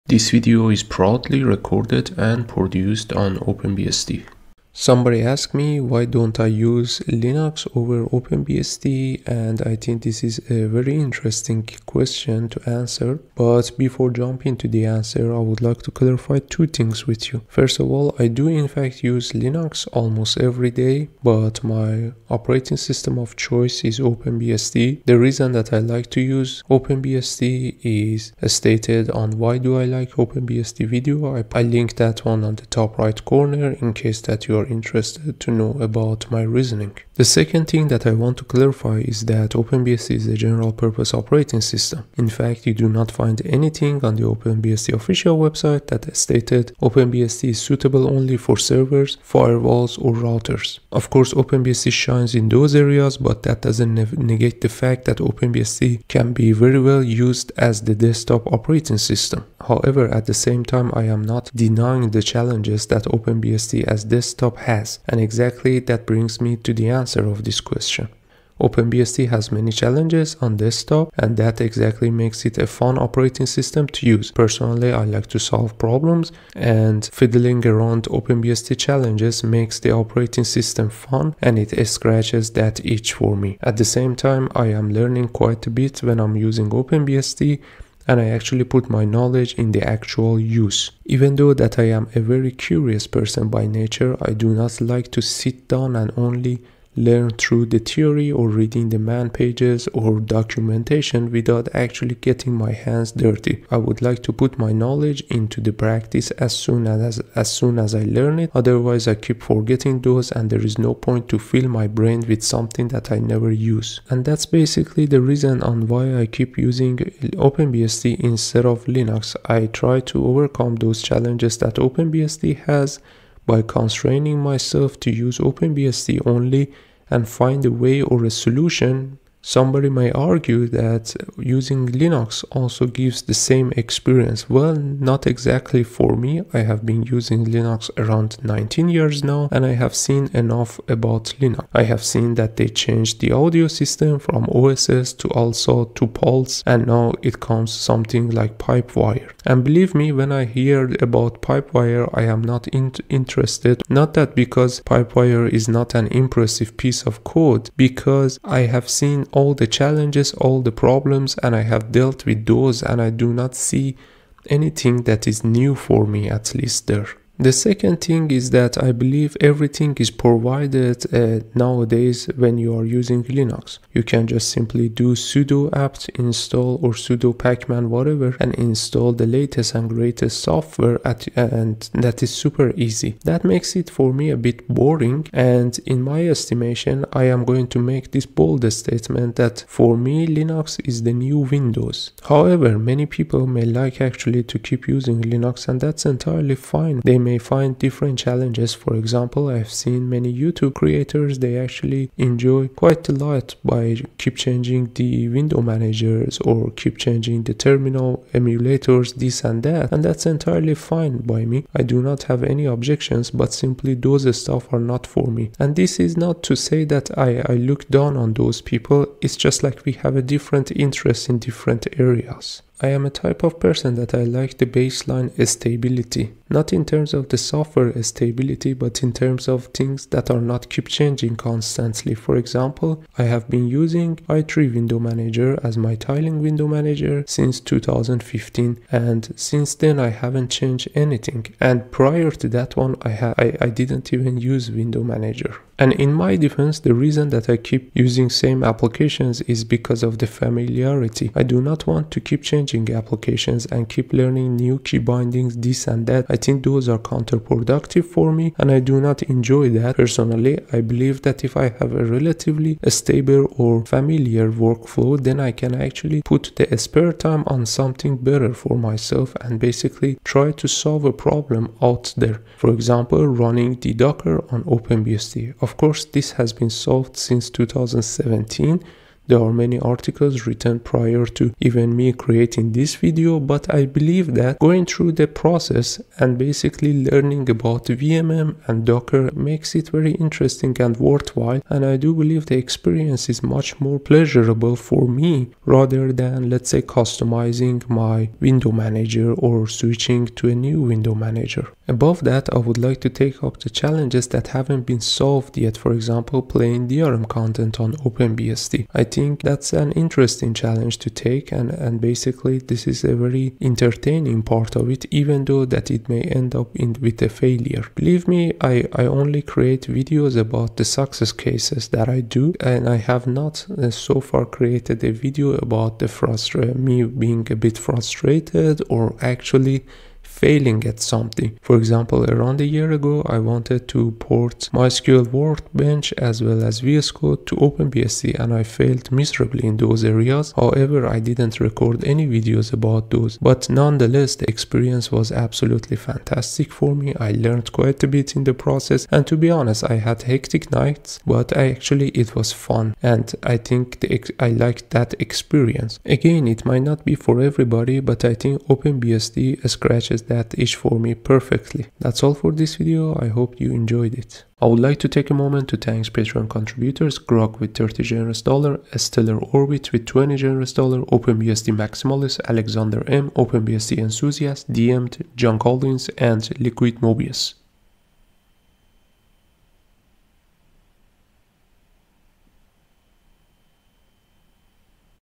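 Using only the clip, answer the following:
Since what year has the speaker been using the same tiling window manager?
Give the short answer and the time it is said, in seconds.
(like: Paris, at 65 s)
2015, at 237 s.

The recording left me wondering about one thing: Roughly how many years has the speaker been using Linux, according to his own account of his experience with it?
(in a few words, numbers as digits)
19 years.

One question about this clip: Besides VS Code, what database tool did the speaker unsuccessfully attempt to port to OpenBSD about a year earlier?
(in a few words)
MySQL Workbench.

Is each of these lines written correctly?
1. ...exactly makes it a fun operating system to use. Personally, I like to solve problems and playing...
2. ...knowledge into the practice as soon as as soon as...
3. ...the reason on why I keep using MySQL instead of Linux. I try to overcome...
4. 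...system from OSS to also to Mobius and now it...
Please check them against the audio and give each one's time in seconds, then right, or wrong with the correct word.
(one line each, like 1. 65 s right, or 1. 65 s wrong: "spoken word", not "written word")
1. 71 s wrong: "fiddling", not "playing"
2. 104 s right
3. 115 s wrong: "OpenBSD", not "MySQL"
4. 143 s wrong: "Pulse", not "Mobius".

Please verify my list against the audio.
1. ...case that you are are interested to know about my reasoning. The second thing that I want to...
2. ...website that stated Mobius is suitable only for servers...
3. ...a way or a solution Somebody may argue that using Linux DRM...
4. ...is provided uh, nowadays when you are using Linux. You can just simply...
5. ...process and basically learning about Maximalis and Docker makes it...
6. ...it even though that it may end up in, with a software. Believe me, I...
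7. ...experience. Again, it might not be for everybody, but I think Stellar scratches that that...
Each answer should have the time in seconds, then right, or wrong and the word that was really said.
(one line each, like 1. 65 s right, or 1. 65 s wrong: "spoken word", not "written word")
1. 33 s right
2. 45 s wrong: "OpenBSD", not "Mobius"
3. 127 s wrong: "ALSA", not "DRM"
4. 169 s right
5. 285 s wrong: "VMM", not "Maximalis"
6. 314 s wrong: "failure", not "software"
7. 355 s wrong: "OpenBSD", not "Stellar".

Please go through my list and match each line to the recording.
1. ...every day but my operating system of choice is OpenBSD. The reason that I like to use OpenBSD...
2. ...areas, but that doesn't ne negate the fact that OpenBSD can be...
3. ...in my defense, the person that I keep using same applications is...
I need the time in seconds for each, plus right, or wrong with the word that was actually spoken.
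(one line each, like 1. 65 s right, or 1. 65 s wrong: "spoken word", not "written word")
1. 20 s right
2. 52 s right
3. 245 s wrong: "reason", not "person".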